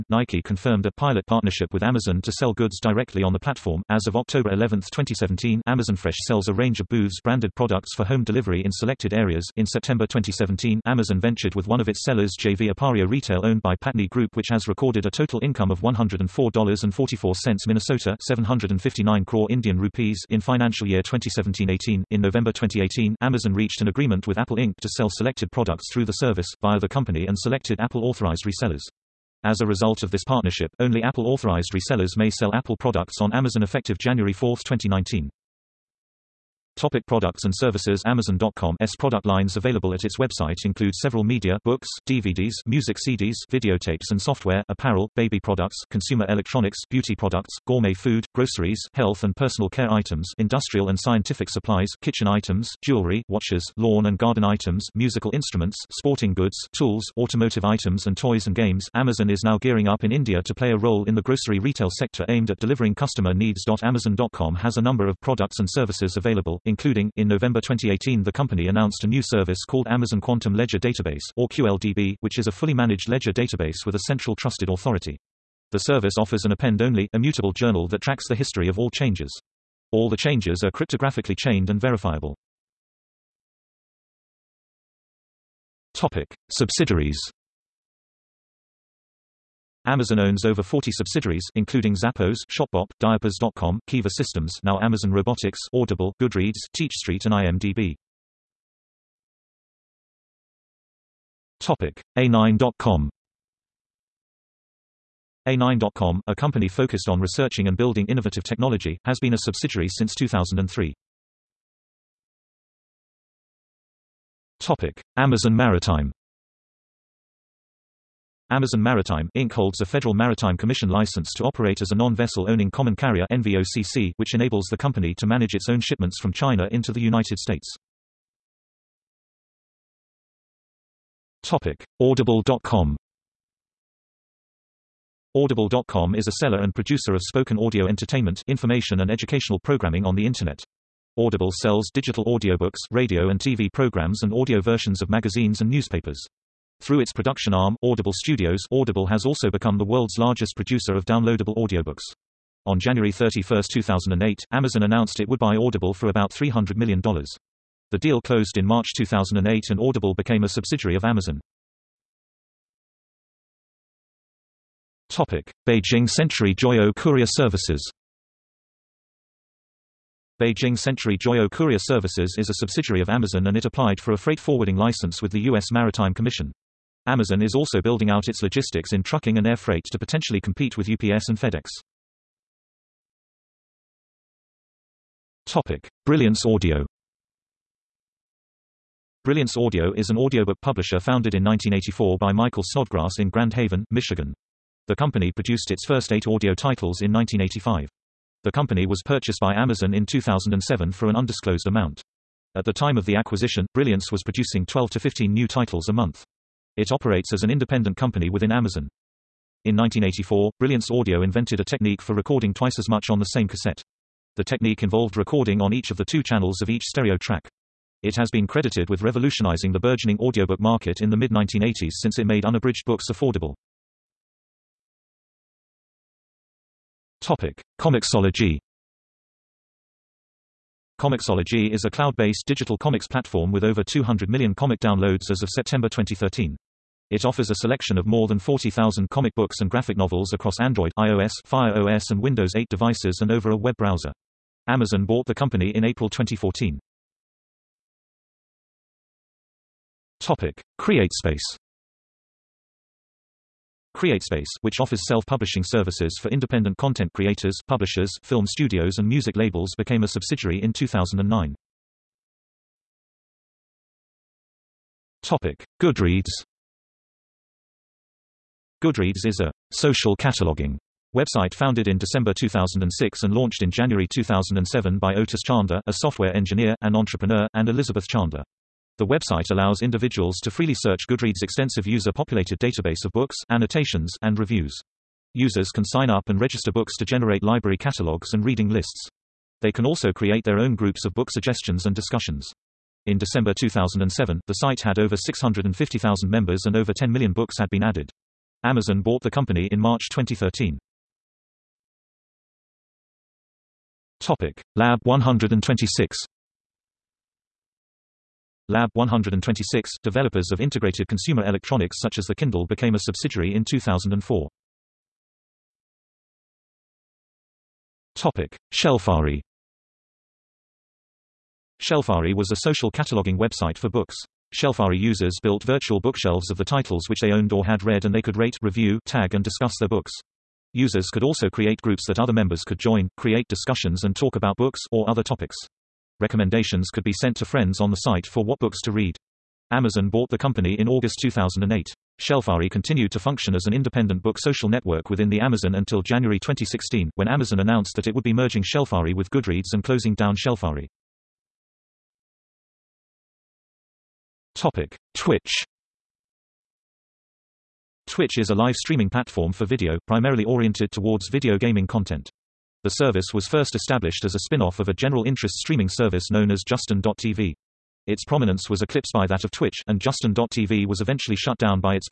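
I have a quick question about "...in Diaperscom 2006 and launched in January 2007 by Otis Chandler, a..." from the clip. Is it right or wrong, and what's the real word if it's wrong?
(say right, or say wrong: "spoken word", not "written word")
wrong: "December", not "Diaperscom".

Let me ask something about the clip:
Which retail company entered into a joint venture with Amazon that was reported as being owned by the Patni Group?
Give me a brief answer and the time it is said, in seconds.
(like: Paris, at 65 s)
Appario Retail, at 12 s.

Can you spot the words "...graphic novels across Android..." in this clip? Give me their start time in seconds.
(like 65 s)
239 s.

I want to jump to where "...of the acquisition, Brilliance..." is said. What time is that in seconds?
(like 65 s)
202 s.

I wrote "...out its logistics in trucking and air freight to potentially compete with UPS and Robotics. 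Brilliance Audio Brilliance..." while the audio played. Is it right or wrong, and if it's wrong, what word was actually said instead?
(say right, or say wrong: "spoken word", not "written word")
wrong: "FedEx", not "Robotics".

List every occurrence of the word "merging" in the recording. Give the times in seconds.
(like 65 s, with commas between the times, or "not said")
348 s.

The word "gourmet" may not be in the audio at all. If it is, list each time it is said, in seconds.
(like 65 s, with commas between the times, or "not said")
47 s.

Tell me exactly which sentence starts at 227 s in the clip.
Comixology Comixology is a cloud-based digital comics platform with over 200 million comic downloads as of September 2013.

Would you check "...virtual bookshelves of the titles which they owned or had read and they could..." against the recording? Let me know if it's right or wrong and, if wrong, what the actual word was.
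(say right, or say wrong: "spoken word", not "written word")
right.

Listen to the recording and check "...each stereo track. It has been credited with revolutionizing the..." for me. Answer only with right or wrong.
right.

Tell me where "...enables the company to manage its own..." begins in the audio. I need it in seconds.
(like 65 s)
124 s.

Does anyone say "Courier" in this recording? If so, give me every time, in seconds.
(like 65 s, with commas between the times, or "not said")
166 s, 171 s.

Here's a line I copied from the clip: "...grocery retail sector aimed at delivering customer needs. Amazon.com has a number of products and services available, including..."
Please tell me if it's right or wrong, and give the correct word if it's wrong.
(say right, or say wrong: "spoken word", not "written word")
right.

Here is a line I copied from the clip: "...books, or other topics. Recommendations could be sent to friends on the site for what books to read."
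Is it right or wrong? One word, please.
right.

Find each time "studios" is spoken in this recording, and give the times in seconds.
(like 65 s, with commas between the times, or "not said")
148 s, 258 s.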